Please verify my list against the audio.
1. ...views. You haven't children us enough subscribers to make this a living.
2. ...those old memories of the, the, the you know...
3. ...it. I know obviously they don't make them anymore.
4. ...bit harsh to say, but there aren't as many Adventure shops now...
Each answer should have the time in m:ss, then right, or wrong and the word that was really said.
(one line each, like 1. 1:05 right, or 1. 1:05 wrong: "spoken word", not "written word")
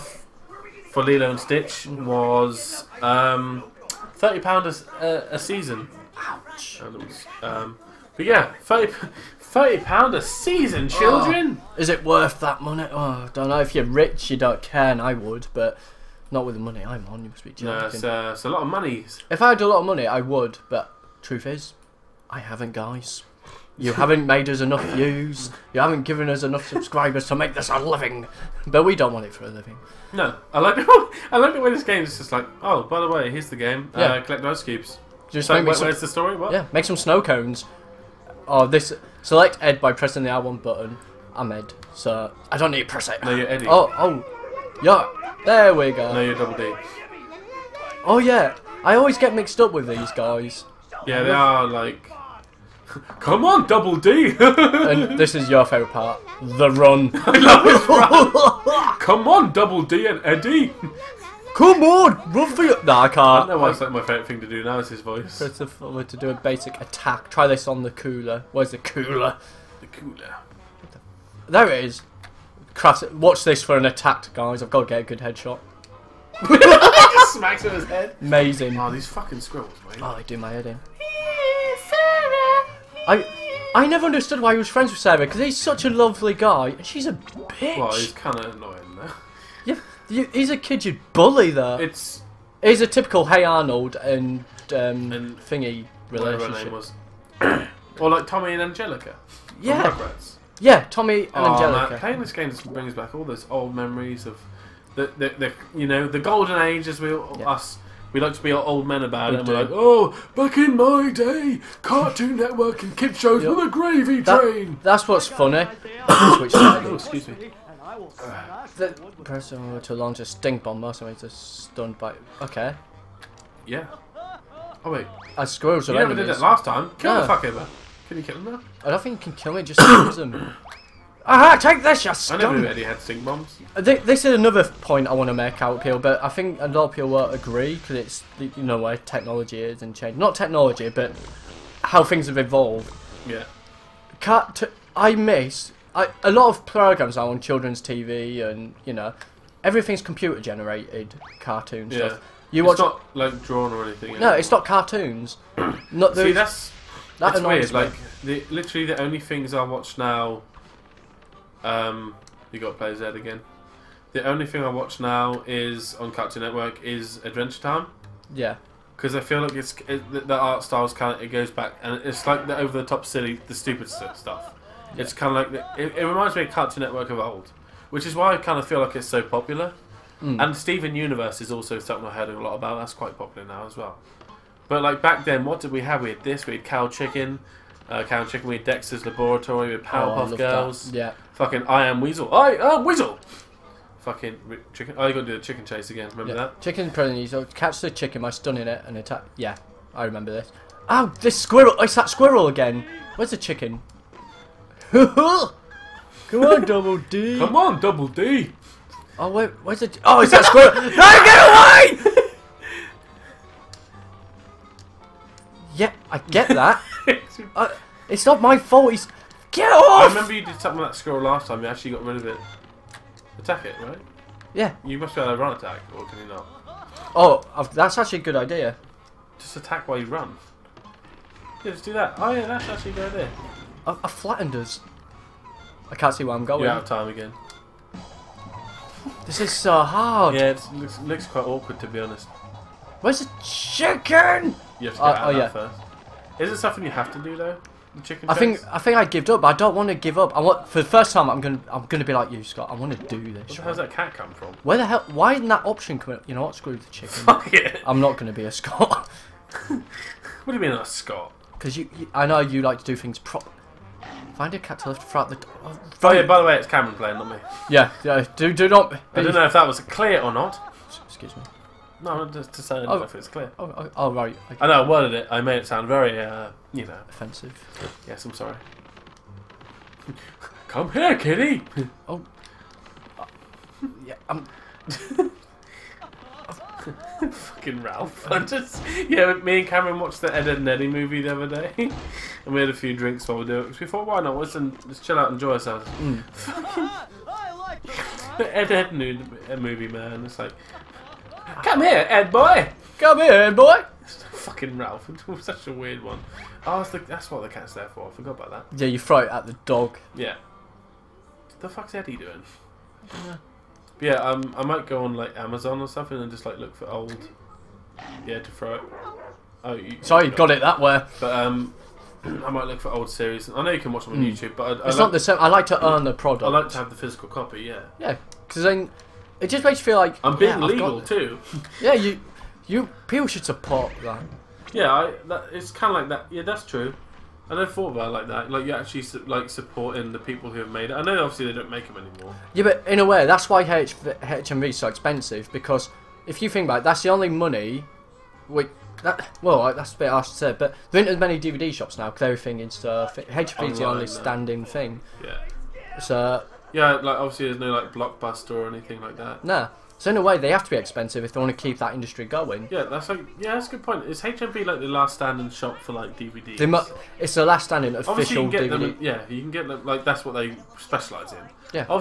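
1. 0:24 wrong: "given", not "children"
2. 1:43 right
3. 5:40 right
4. 5:49 wrong: "DVD", not "Adventure".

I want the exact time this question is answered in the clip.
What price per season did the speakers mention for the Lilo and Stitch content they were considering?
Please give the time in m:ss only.
0:04.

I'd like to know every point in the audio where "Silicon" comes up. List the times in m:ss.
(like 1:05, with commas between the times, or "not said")
not said.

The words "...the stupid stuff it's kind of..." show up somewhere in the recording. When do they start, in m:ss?
2:53.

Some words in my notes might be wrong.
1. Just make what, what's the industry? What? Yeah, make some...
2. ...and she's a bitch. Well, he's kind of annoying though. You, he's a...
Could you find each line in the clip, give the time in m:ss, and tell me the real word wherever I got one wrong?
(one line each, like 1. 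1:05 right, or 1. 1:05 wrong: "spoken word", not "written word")
1. 0:35 wrong: "story", not "industry"
2. 1:26 right.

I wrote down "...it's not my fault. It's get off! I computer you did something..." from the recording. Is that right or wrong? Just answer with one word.
wrong.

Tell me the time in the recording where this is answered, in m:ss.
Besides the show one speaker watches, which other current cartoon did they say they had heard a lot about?
3:00.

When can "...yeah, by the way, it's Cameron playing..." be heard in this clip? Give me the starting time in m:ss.
4:26.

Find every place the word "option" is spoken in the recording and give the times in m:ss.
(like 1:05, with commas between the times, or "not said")
4:15.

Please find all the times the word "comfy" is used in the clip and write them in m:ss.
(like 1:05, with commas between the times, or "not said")
not said.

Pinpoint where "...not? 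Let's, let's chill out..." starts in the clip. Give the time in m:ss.
4:54.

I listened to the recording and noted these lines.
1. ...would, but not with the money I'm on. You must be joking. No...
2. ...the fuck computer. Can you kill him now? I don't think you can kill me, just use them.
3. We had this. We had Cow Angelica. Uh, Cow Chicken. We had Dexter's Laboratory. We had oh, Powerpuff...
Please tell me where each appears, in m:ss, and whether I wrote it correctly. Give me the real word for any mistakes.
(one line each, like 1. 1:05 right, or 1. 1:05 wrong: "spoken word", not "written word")
1. 0:15 right
2. 2:07 wrong: "fucker", not "computer"
3. 3:06 wrong: "Chicken", not "Angelica".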